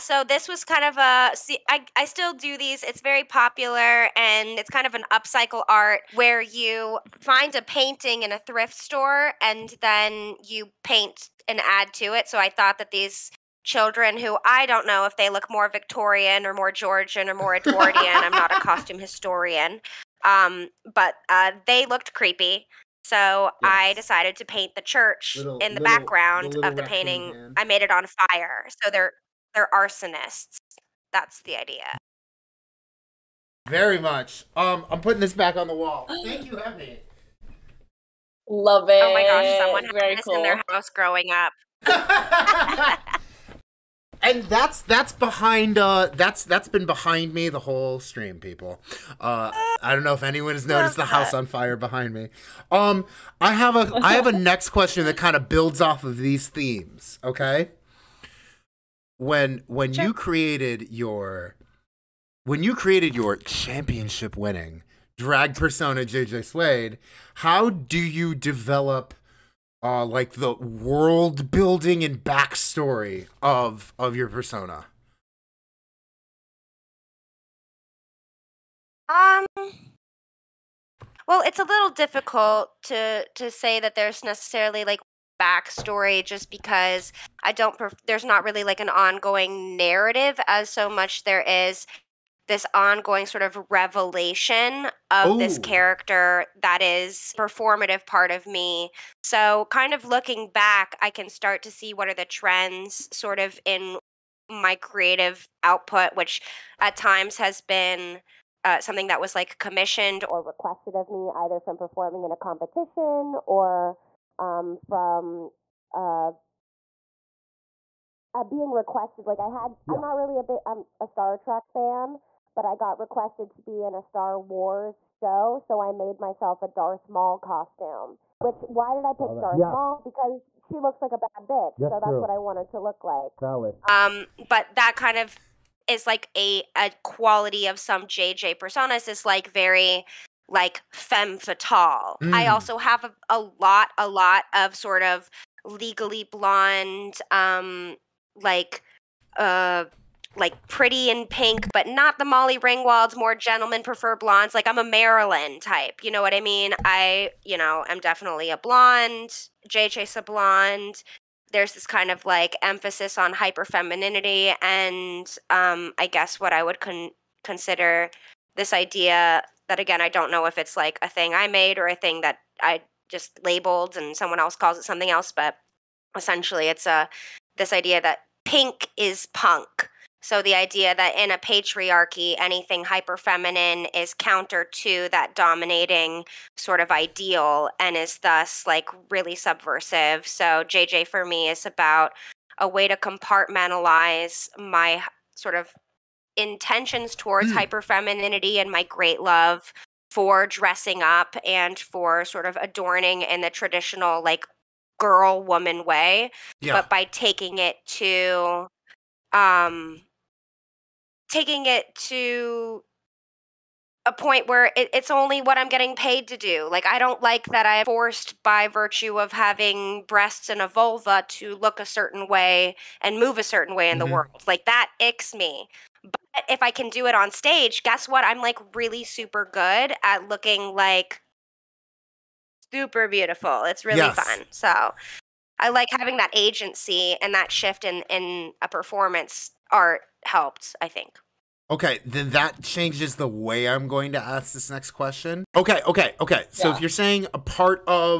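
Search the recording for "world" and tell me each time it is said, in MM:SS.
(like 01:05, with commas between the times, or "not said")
01:10, 03:44.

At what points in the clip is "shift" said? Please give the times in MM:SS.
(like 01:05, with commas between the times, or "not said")
03:57.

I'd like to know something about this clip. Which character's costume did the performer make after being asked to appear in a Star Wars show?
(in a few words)
Darth Maul.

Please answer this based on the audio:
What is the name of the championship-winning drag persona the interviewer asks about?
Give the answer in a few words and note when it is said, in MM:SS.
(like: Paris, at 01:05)
JJ Slade, at 01:06.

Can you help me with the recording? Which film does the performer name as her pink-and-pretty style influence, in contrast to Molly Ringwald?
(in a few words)
Gentlemen Prefer Blondes.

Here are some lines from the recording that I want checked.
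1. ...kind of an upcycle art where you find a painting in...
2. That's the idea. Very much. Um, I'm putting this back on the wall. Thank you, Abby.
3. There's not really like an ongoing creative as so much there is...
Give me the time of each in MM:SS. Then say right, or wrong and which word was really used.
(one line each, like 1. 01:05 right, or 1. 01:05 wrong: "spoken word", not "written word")
1. 00:04 right
2. 00:31 right
3. 01:28 wrong: "narrative", not "creative".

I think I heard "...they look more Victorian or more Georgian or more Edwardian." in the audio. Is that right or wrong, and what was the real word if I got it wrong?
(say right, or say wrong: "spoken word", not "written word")
right.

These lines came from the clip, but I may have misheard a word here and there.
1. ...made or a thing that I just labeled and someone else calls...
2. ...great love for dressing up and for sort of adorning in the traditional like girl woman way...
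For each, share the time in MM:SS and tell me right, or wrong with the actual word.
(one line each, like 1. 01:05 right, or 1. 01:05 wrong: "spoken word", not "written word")
1. 02:51 right
2. 03:18 right.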